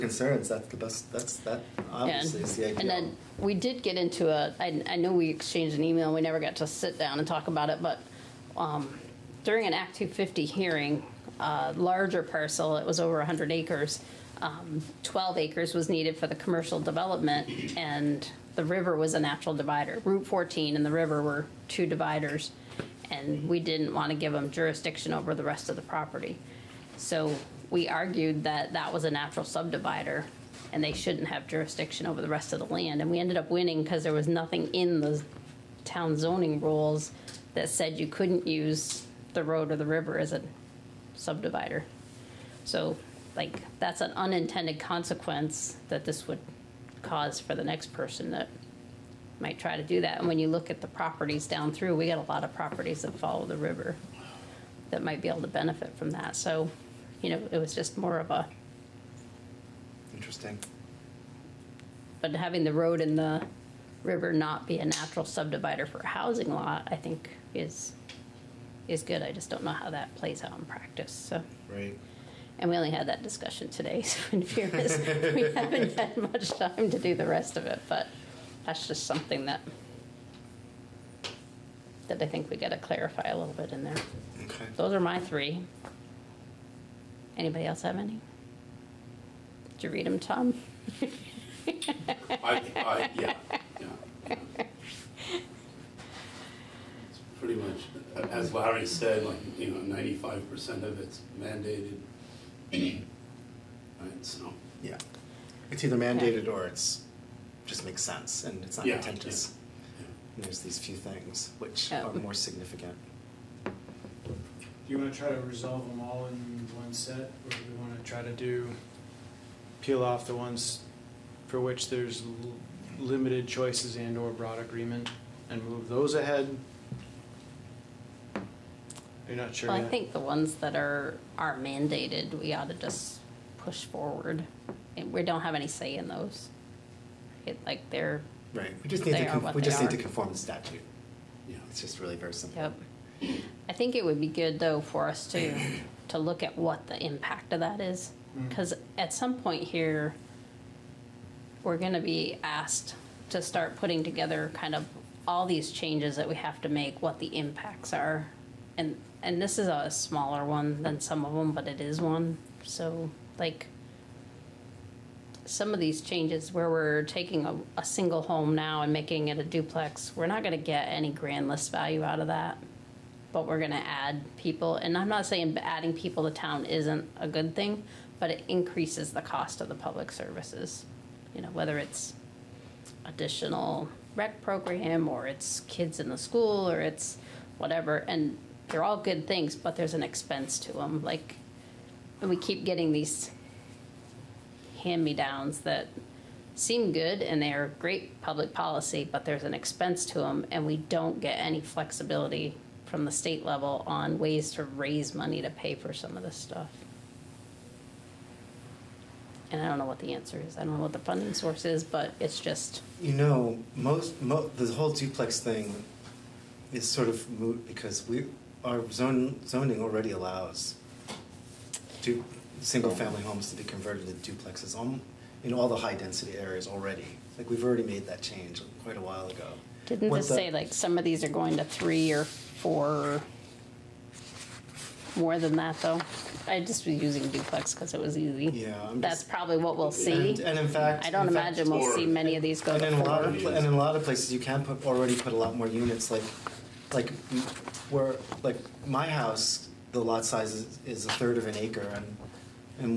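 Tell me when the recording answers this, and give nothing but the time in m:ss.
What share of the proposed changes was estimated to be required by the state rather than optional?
1:39.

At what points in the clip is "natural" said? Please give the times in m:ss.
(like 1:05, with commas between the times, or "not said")
0:19, 0:29, 1:04.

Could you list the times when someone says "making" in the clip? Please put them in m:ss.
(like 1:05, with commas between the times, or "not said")
2:48.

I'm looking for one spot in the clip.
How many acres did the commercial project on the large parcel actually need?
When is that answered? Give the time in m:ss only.
0:15.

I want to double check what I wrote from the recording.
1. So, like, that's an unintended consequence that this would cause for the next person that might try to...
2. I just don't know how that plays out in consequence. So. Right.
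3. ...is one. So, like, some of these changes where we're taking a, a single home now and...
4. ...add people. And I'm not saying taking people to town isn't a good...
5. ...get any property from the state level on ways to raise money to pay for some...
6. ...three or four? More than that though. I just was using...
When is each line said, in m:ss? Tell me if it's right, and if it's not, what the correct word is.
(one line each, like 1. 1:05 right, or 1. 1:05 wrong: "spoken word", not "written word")
1. 0:42 right
2. 1:09 wrong: "practice", not "consequence"
3. 2:41 right
4. 2:53 wrong: "adding", not "taking"
5. 3:21 wrong: "flexibility", not "property"
6. 3:51 right.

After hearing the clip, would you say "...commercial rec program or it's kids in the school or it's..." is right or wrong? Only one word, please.
wrong.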